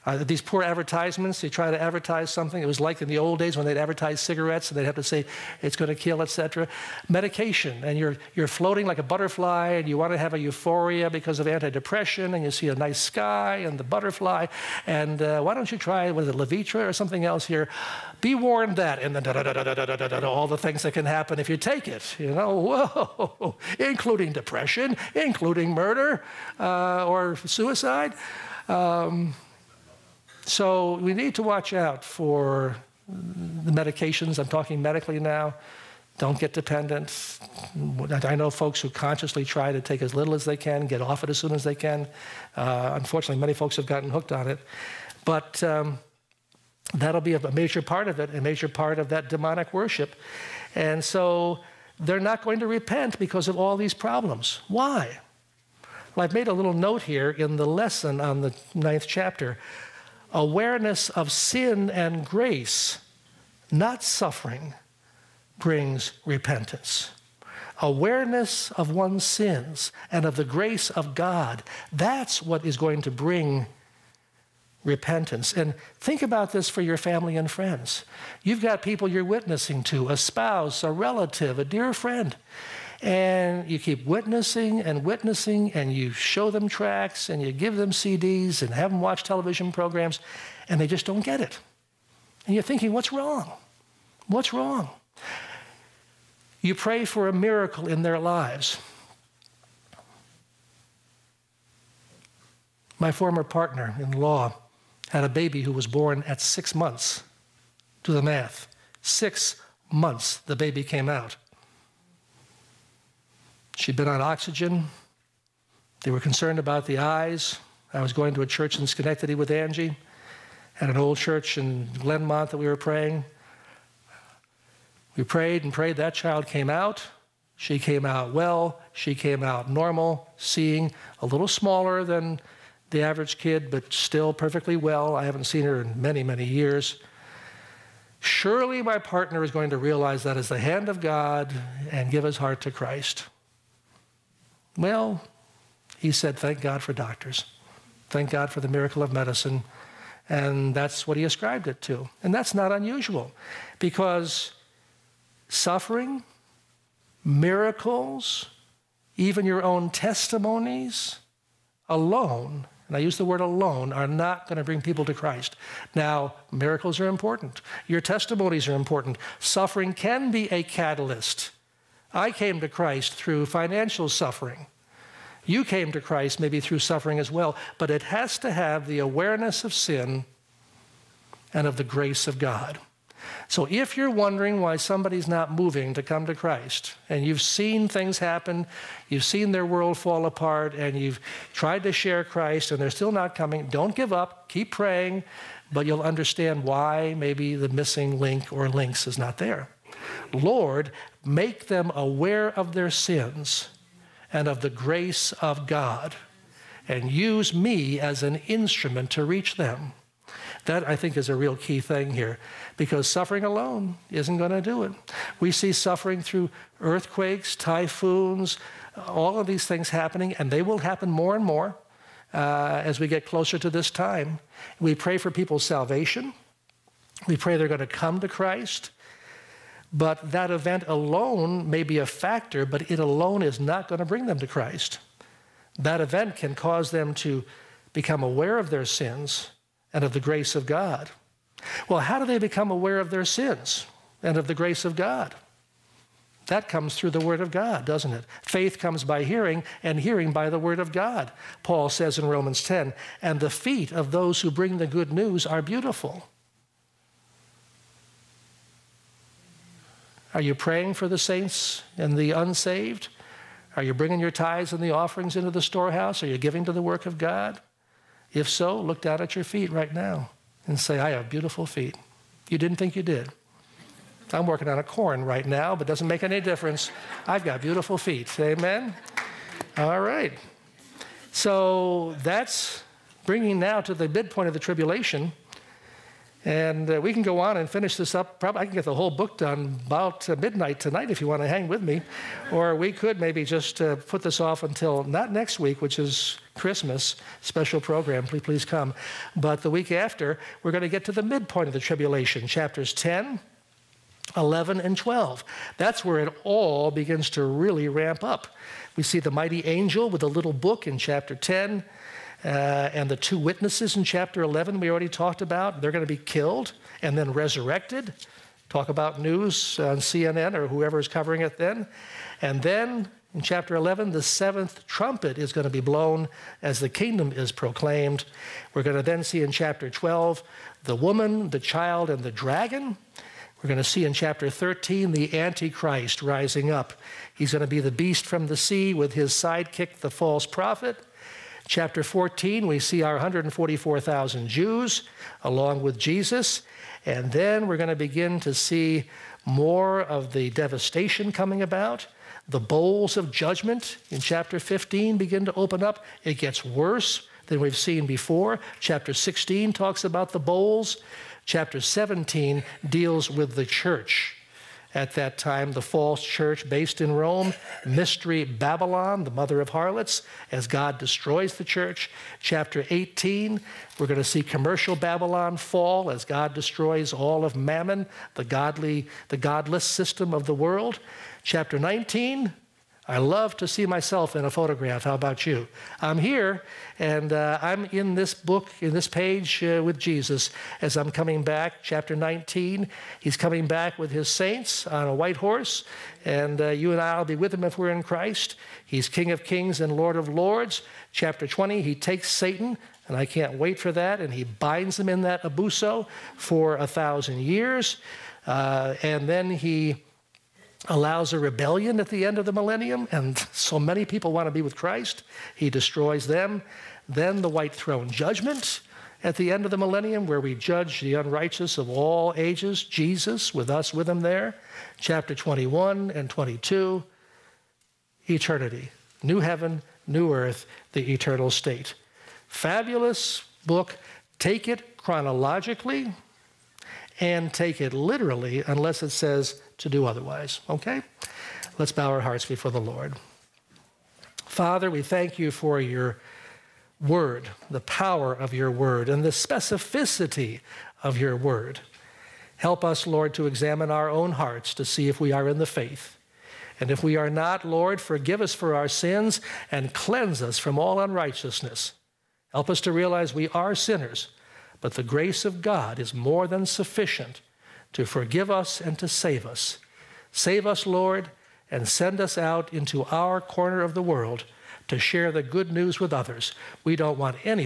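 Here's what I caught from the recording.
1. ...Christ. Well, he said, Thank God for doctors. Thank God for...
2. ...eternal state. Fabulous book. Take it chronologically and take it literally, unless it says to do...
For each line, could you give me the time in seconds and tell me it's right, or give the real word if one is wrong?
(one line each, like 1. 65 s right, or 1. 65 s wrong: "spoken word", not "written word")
1. 142 s right
2. 431 s right.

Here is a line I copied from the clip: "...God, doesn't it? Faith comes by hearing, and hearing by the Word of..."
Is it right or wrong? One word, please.
right.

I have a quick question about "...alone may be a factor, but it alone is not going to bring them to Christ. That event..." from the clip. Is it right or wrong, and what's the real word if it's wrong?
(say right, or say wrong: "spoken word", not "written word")
right.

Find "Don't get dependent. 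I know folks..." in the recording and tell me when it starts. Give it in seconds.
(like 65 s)
36 s.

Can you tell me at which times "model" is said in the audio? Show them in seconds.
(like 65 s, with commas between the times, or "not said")
not said.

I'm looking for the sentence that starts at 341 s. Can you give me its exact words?
Chapter 14, we see our 144,000 Jews along with Jesus.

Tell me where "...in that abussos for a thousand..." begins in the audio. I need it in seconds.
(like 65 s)
405 s.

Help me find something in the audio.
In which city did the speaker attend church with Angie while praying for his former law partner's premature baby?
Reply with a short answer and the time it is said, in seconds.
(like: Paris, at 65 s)
Schenectady, at 118 s.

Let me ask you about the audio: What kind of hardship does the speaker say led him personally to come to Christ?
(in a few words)
financial suffering.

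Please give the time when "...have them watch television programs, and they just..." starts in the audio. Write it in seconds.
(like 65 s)
88 s.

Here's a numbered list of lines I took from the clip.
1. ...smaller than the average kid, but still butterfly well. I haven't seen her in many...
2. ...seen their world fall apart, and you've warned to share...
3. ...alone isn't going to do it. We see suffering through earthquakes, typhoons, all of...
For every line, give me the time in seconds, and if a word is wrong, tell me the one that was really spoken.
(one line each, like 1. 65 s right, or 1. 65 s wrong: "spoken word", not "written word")
1. 131 s wrong: "perfectly", not "butterfly"
2. 189 s wrong: "tried", not "warned"
3. 213 s right.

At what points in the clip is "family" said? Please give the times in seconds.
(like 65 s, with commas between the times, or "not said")
76 s.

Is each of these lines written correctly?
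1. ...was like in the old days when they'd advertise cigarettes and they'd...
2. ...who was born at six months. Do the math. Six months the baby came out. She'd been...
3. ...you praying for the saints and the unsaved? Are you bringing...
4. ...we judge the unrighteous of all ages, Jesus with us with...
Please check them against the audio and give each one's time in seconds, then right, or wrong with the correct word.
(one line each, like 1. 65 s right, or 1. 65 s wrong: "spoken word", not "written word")
1. 2 s right
2. 105 s right
3. 260 s right
4. 420 s right.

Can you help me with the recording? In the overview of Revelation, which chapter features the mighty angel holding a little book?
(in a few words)
chapter 10.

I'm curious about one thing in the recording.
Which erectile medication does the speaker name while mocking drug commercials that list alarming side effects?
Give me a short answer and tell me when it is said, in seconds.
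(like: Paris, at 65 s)
Levitra, at 16 s.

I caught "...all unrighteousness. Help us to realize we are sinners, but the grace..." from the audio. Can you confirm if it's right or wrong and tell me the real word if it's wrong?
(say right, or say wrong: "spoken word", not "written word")
right.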